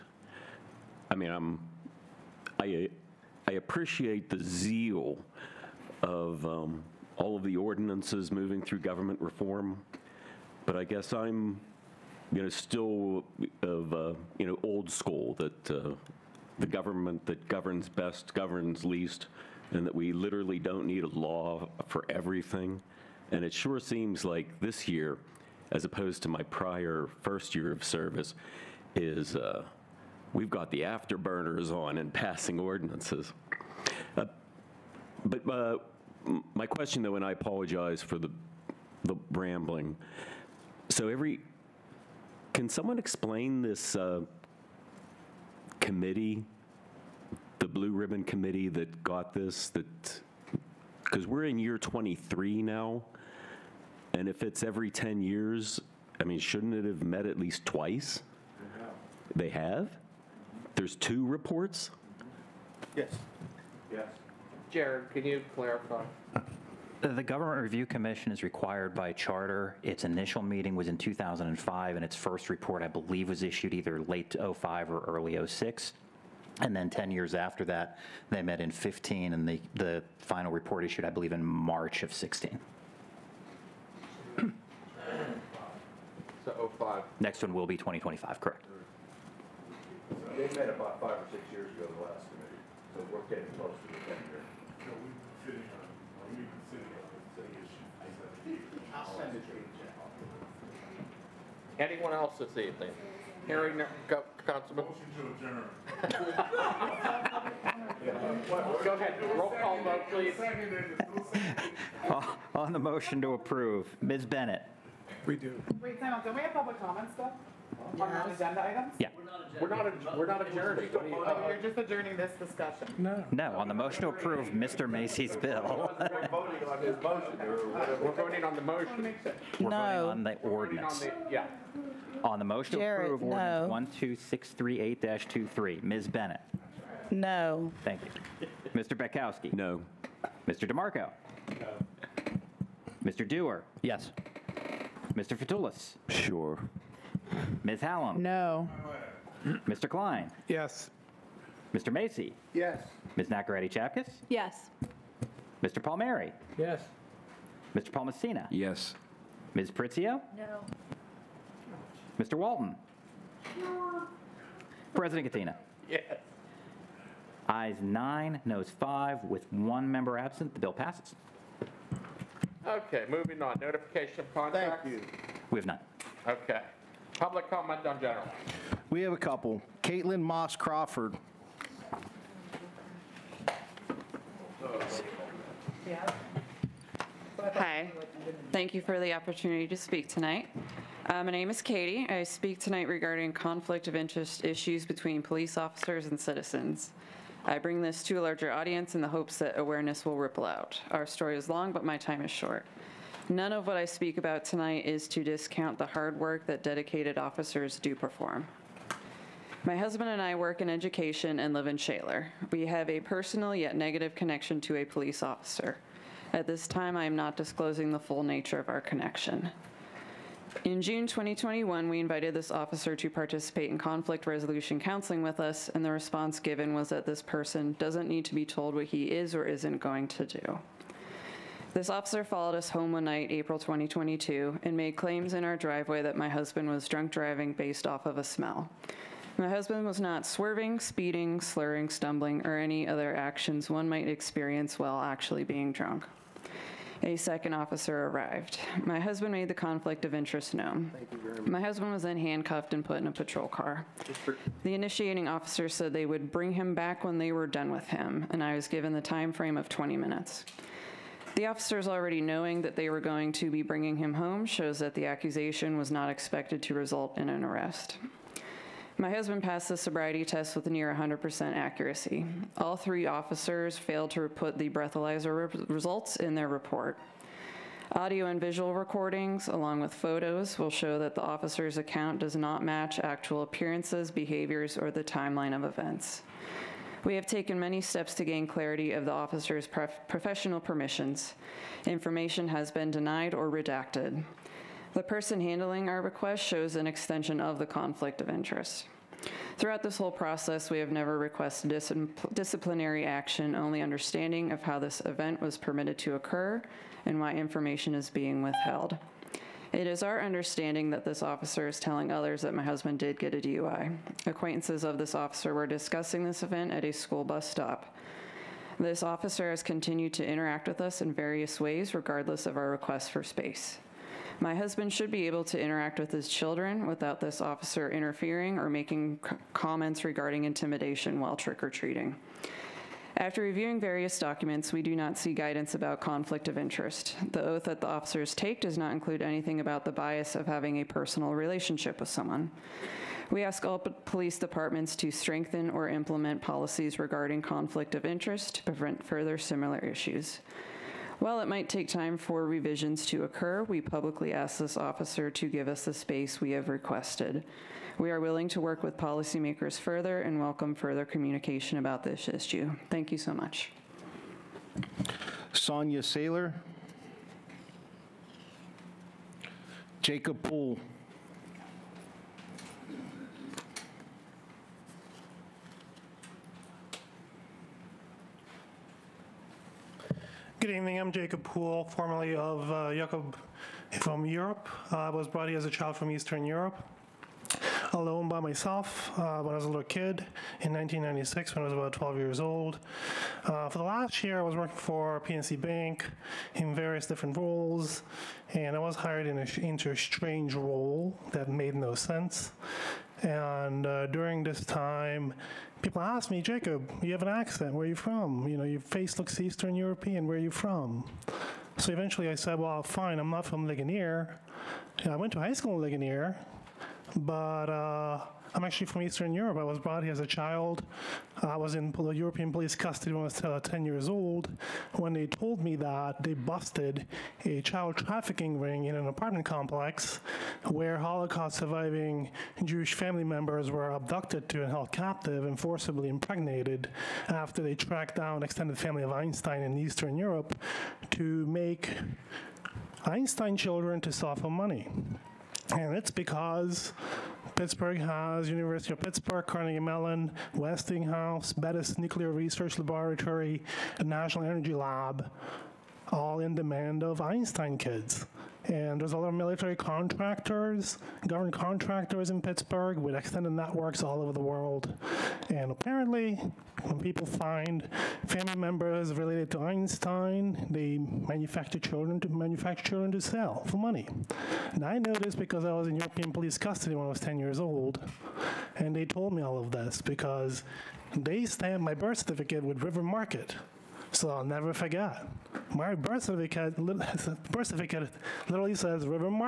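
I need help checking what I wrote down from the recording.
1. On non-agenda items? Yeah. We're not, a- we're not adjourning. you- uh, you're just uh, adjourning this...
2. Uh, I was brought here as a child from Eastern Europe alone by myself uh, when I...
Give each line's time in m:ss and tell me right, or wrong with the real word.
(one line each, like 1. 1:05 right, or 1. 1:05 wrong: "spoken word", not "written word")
1. 1:57 right
2. 6:24 right.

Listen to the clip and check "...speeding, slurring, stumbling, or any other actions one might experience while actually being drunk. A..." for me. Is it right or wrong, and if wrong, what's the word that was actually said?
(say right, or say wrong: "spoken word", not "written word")
right.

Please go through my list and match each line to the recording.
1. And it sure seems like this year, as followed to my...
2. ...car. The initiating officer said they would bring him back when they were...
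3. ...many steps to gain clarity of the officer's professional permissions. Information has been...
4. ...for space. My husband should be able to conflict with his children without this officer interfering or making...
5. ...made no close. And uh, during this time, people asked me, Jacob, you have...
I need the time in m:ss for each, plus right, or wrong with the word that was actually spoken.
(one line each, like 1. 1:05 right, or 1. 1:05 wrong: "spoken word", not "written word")
1. 0:23 wrong: "opposed", not "followed"
2. 4:13 right
3. 4:47 right
4. 5:23 wrong: "interact", not "conflict"
5. 6:41 wrong: "sense", not "close".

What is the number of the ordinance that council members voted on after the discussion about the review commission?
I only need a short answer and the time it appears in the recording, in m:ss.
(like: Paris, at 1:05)
12638-23, at 2:13.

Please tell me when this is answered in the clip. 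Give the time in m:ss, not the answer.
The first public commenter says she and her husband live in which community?
3:31.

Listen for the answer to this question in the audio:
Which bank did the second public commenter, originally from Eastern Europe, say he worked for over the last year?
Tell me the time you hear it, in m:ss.
6:35.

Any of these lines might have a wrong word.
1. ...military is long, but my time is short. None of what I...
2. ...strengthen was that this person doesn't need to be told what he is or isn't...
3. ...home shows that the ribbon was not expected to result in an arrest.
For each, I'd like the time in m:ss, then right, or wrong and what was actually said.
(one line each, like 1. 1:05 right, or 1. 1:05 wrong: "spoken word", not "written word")
1. 3:21 wrong: "story", not "military"
2. 3:46 wrong: "given", not "strengthen"
3. 4:24 wrong: "accusation", not "ribbon".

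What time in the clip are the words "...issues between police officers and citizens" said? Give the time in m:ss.
3:14.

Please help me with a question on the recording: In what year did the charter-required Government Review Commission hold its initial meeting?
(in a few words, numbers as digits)
2005.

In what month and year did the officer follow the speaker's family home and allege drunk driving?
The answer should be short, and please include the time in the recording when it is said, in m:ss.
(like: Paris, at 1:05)
April 2022, at 3:53.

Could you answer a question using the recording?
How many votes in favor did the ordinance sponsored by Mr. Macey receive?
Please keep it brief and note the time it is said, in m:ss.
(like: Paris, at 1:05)
9, at 2:47.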